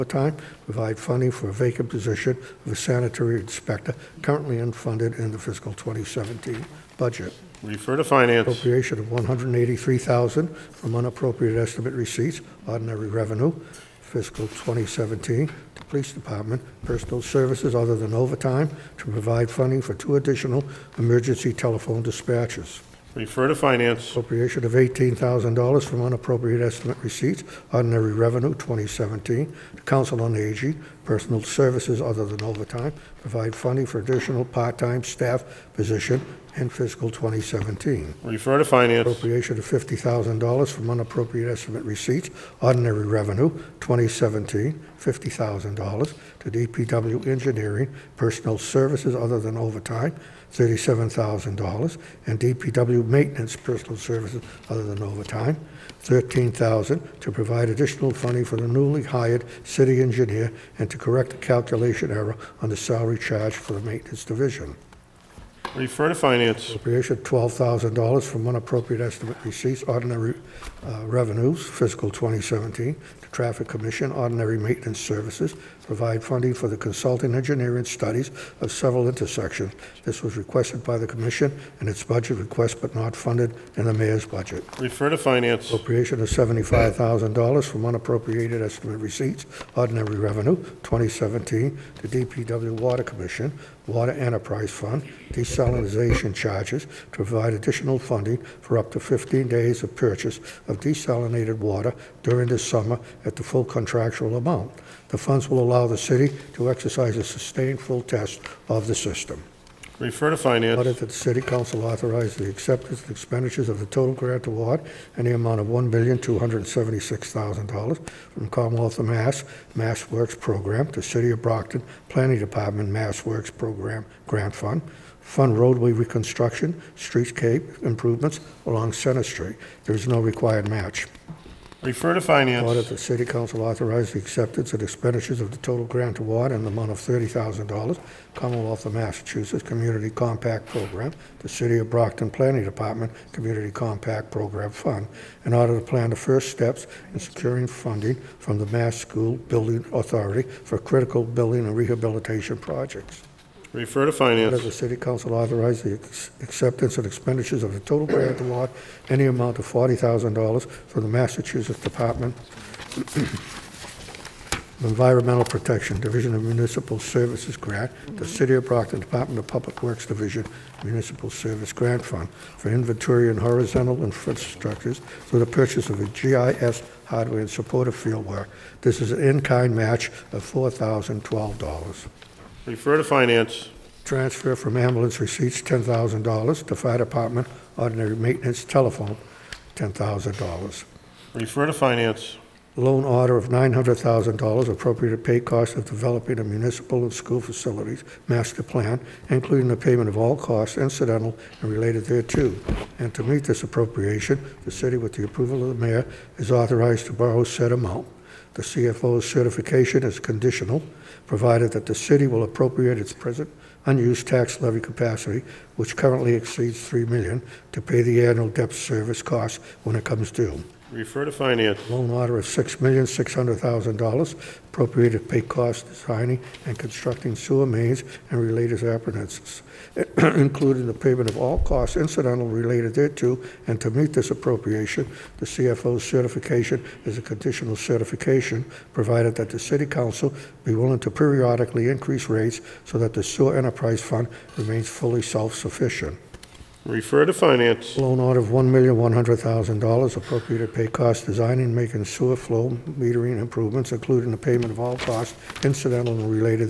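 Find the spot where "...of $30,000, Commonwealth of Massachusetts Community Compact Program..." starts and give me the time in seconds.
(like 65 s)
136 s.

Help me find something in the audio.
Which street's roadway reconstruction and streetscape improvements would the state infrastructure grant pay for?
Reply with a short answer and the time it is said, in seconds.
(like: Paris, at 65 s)
Center Street, at 128 s.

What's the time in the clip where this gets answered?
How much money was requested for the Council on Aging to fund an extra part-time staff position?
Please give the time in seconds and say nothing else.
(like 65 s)
24 s.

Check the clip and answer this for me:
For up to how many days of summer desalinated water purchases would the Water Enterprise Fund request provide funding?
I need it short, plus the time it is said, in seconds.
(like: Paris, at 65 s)
15, at 98 s.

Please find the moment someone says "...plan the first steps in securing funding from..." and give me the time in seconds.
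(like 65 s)
145 s.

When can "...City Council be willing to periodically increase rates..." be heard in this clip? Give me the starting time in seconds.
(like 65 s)
239 s.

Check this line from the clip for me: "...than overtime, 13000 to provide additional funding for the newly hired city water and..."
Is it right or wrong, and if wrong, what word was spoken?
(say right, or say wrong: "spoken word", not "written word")
wrong: "engineer", not "water".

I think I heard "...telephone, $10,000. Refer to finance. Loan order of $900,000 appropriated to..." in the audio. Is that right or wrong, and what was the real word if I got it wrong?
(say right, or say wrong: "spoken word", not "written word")
right.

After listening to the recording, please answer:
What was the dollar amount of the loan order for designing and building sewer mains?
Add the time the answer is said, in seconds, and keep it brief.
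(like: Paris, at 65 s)
$6,600,000, at 222 s.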